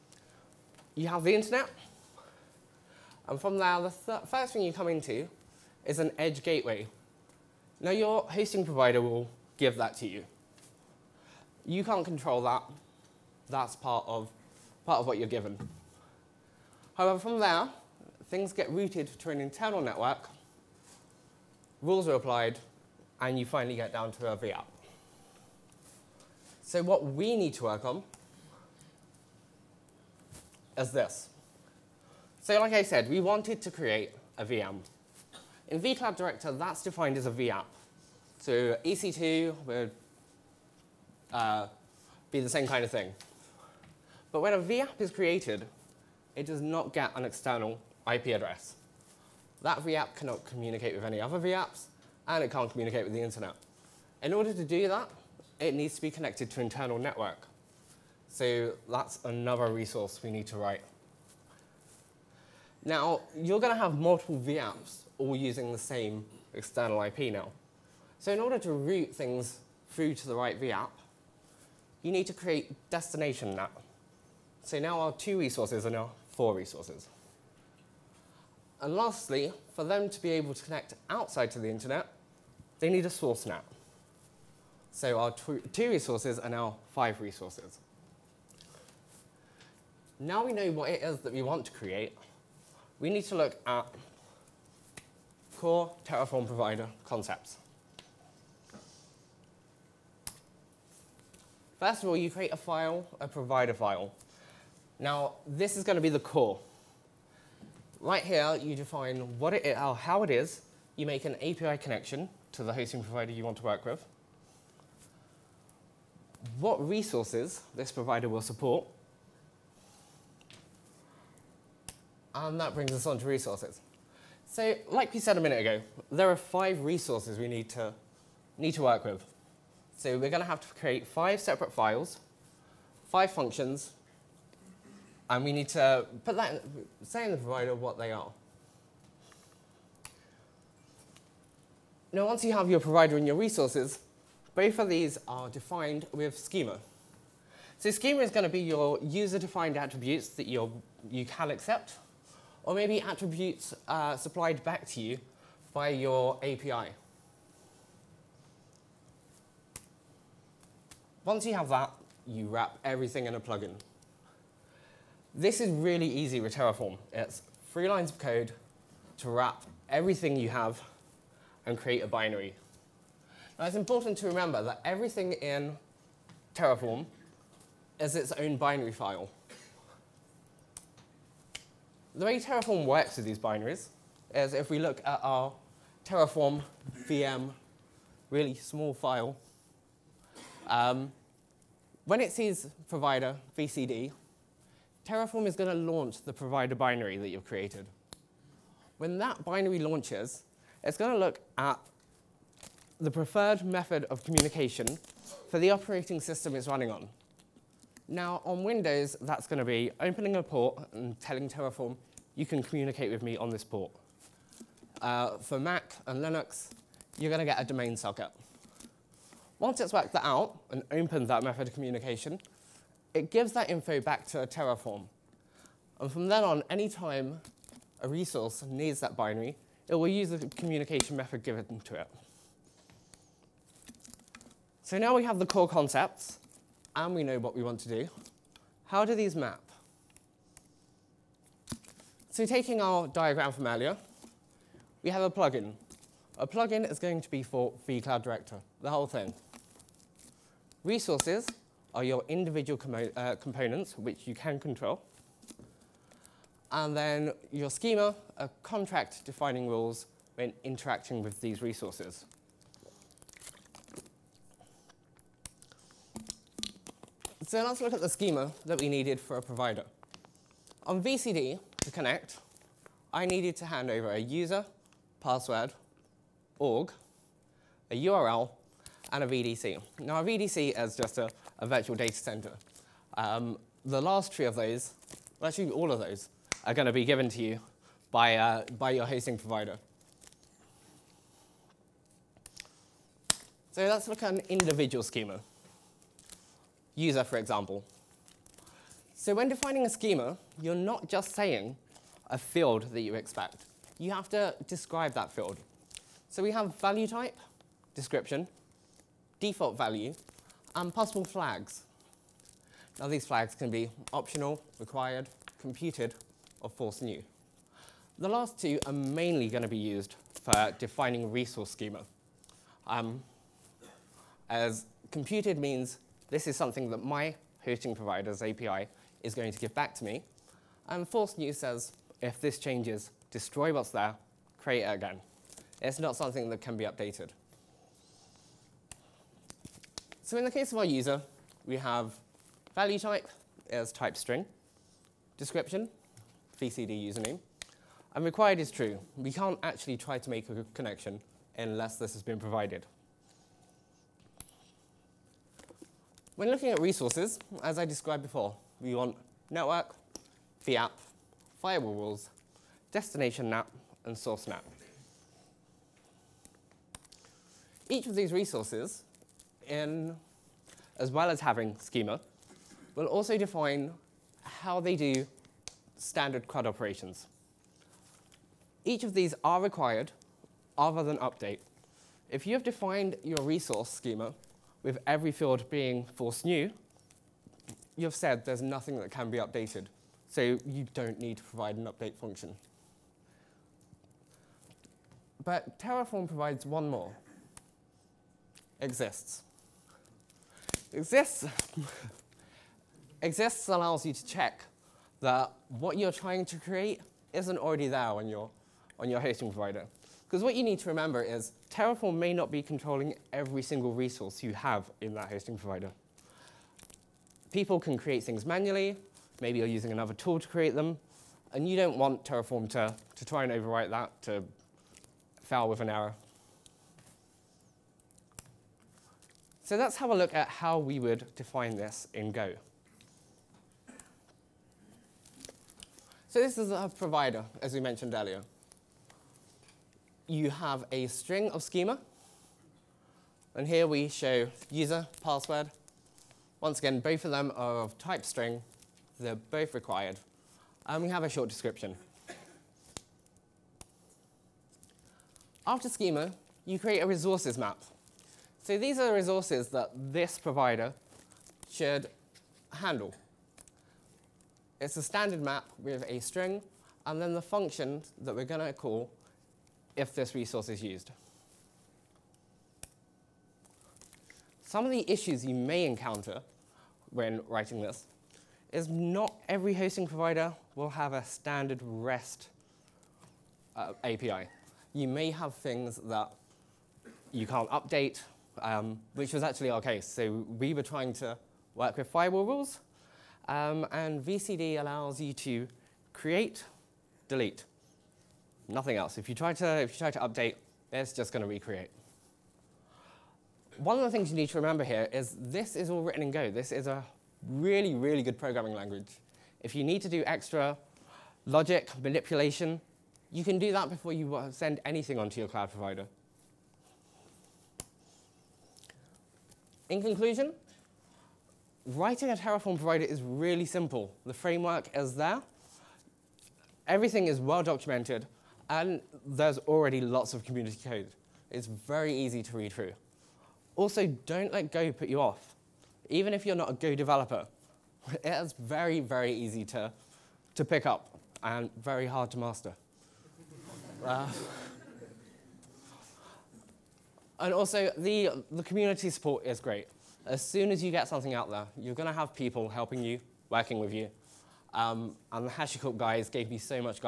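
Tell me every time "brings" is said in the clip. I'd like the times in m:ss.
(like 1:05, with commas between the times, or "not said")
2:02.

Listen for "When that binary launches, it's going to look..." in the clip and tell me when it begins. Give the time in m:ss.
3:18.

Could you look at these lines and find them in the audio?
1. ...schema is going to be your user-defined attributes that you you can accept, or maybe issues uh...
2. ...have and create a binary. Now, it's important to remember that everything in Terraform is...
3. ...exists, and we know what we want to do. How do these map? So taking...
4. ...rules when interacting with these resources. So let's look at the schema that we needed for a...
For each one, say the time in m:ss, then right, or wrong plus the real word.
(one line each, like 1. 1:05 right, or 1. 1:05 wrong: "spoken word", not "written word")
1. 2:27 wrong: "attributes", not "issues"
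2. 2:50 right
3. 3:55 wrong: "concepts", not "exists"
4. 4:19 right.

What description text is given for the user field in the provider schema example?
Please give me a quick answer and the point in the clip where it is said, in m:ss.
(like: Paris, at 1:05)
VCD username, at 5:46.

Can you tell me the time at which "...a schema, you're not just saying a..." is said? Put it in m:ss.
4:59.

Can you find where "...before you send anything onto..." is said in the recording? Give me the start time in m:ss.
8:33.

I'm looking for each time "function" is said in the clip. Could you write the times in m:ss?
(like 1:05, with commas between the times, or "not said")
2:13, 6:32, 7:47.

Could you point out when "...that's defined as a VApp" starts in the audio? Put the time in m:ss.
0:36.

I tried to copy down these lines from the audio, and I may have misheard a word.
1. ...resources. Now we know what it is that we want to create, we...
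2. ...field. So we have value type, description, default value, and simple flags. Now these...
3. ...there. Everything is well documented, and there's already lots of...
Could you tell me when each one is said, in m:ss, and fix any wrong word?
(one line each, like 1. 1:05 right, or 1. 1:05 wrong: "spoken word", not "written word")
1. 1:27 right
2. 5:05 wrong: "possible", not "simple"
3. 8:45 right.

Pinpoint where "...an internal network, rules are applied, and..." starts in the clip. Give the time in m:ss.
0:19.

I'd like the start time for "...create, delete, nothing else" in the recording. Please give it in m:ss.
8:16.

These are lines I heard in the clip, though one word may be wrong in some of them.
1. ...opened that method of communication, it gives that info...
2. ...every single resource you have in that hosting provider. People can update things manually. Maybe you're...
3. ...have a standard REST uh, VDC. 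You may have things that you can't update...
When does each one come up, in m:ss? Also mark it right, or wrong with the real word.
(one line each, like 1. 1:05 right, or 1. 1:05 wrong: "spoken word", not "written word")
1. 3:40 right
2. 6:53 wrong: "create", not "update"
3. 8:00 wrong: "API", not "VDC".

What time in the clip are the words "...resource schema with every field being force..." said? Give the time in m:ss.
6:23.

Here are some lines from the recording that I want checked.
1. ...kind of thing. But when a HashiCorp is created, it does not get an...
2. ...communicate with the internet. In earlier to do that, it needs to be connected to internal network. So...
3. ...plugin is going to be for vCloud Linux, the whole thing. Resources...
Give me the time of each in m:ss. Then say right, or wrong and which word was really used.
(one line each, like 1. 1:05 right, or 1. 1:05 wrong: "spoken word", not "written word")
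1. 0:42 wrong: "VApp", not "HashiCorp"
2. 0:52 wrong: "order", not "earlier"
3. 4:06 wrong: "Director", not "Linux".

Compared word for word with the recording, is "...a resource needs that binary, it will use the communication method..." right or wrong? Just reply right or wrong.
right.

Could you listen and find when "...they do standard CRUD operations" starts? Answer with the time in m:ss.
6:14.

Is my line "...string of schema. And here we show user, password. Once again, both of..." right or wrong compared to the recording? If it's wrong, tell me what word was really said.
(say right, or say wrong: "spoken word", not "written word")
right.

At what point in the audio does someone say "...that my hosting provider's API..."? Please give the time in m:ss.
5:26.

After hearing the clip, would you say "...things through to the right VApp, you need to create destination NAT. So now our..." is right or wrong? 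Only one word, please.
right.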